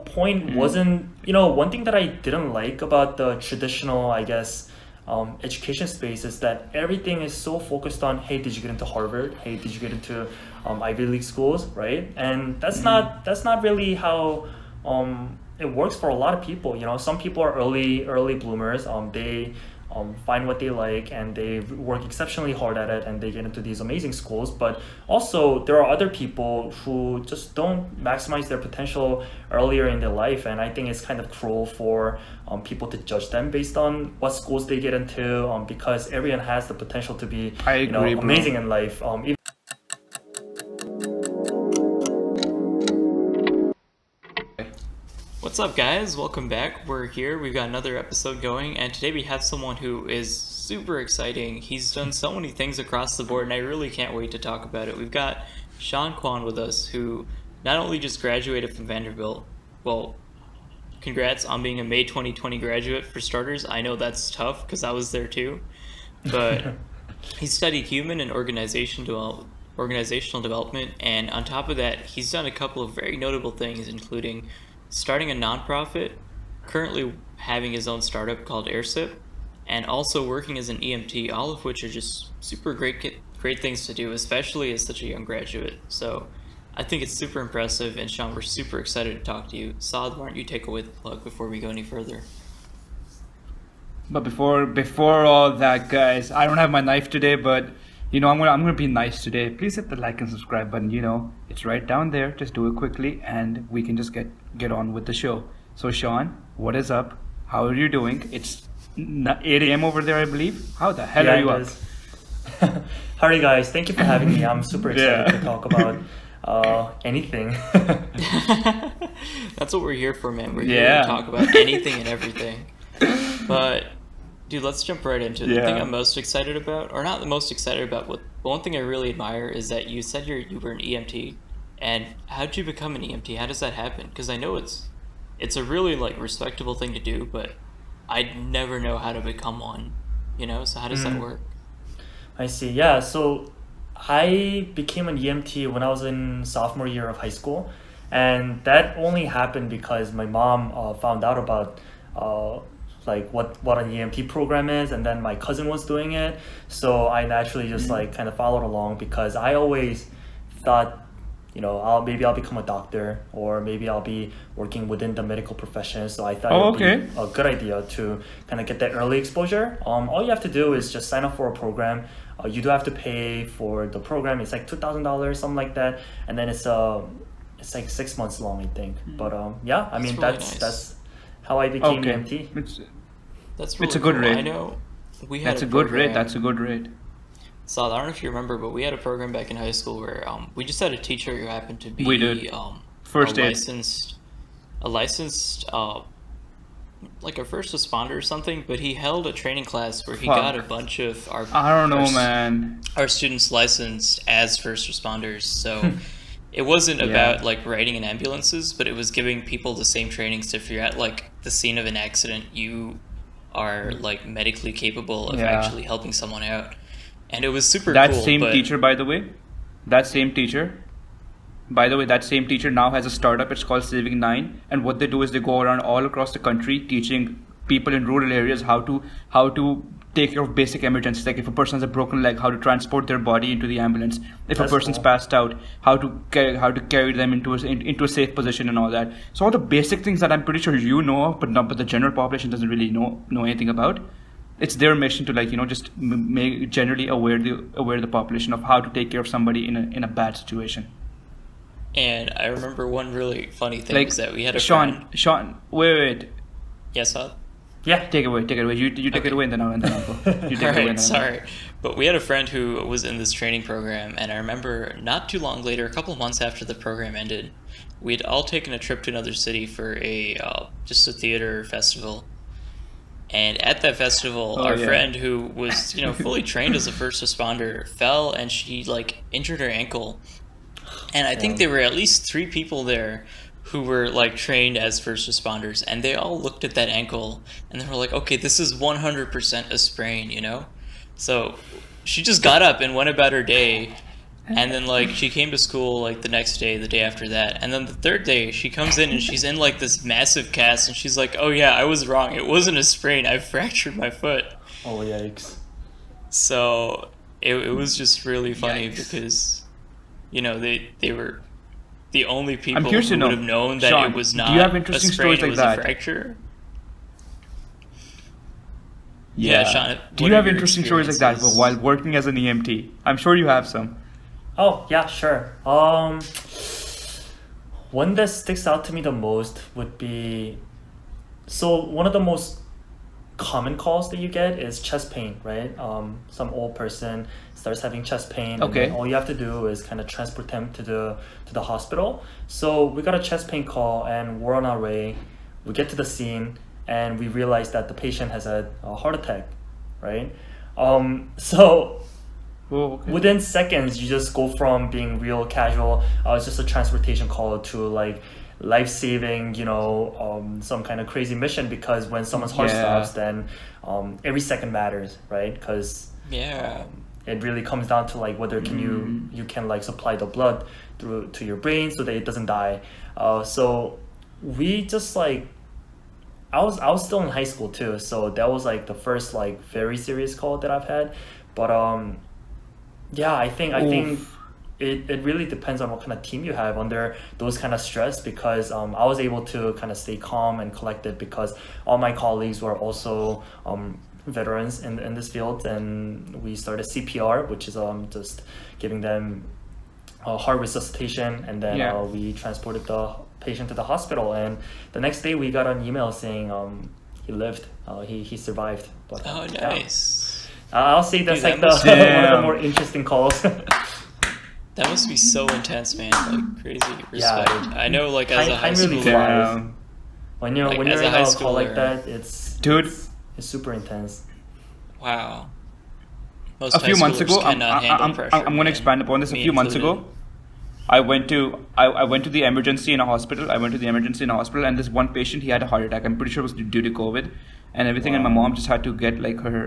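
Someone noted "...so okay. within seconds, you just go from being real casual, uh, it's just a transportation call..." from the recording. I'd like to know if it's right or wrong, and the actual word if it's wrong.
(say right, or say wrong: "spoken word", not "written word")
right.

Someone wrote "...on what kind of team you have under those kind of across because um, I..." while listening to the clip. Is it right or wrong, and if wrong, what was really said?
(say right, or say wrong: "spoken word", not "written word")
wrong: "stress", not "across".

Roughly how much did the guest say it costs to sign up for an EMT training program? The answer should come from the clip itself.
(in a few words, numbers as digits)
$2,000.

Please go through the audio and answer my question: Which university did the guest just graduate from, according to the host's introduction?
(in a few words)
Vanderbilt.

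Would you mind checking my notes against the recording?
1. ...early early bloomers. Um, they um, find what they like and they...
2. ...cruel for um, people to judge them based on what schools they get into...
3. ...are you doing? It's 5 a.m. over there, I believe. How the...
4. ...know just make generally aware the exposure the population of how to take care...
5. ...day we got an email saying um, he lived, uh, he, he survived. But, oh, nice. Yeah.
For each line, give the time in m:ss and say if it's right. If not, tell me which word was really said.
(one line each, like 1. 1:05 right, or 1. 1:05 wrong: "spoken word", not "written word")
1. 0:17 right
2. 0:31 right
3. 1:47 wrong: "8", not "5"
4. 4:05 wrong: "aware", not "exposure"
5. 6:45 right.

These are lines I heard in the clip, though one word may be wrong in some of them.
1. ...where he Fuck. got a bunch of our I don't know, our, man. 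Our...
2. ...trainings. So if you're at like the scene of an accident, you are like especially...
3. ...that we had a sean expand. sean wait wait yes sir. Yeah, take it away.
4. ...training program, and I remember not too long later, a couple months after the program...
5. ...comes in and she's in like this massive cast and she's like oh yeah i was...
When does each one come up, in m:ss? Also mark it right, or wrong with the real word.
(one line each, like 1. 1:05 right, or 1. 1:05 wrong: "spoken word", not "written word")
1. 3:20 right
2. 3:30 wrong: "medically", not "especially"
3. 4:14 wrong: "friend", not "expand"
4. 4:23 right
5. 4:58 right.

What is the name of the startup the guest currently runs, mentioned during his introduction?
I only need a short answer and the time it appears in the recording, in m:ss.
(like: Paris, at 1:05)
AirSip, at 1:18.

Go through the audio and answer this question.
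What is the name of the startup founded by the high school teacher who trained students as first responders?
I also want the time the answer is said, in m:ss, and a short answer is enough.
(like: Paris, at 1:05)
Saving Nine, at 3:43.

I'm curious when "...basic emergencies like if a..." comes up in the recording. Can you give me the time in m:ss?
3:50.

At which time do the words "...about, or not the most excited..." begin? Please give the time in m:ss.
2:06.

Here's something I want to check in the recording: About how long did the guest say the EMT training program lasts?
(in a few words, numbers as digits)
6 months.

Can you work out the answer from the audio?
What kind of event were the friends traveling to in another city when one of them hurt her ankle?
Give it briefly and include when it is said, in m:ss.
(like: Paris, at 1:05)
theater festival, at 4:31.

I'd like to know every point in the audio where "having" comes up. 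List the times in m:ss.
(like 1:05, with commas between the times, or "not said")
1:17, 1:54, 5:37.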